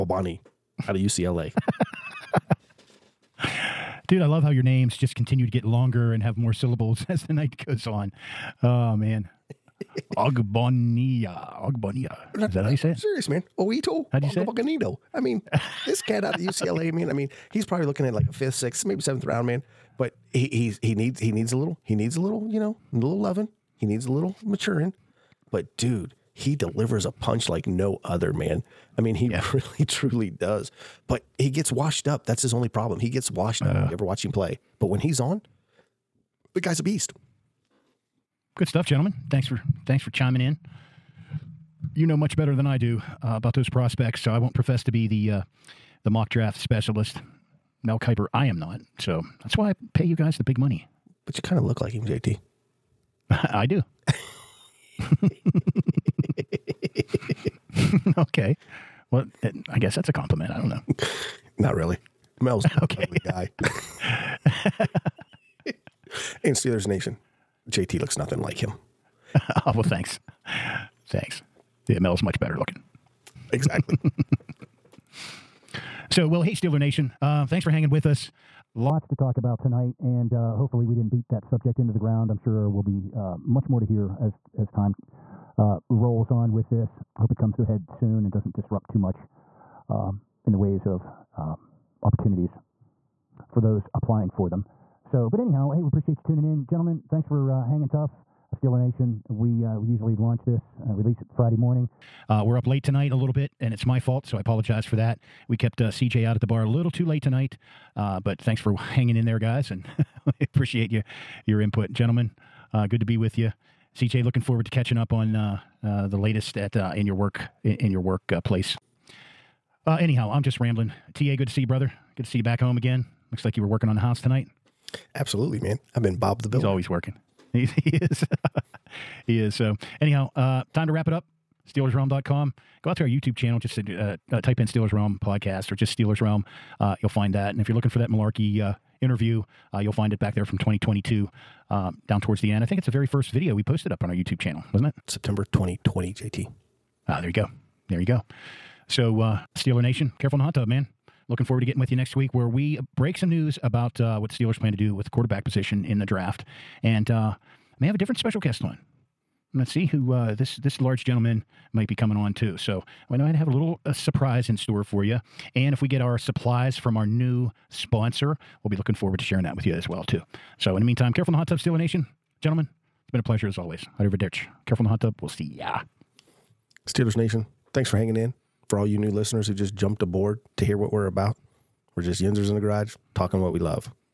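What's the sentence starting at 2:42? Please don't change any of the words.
So I know I'd have a little a surprise in store for you.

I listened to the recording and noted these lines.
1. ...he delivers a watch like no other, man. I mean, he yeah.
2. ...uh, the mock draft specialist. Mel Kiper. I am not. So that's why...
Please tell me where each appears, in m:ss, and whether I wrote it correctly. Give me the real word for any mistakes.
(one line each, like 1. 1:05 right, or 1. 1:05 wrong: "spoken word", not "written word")
1. 0:26 wrong: "punch", not "watch"
2. 0:45 right.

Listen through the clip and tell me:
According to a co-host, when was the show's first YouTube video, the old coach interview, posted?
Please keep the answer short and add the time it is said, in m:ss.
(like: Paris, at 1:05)
September 2020, at 2:25.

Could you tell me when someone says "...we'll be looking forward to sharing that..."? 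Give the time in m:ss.
2:48.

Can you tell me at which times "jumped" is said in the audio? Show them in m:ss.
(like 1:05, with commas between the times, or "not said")
2:59.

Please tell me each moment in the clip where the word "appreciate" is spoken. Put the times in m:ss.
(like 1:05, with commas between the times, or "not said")
1:35, 1:50.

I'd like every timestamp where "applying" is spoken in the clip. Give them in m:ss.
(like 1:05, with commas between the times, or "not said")
1:33.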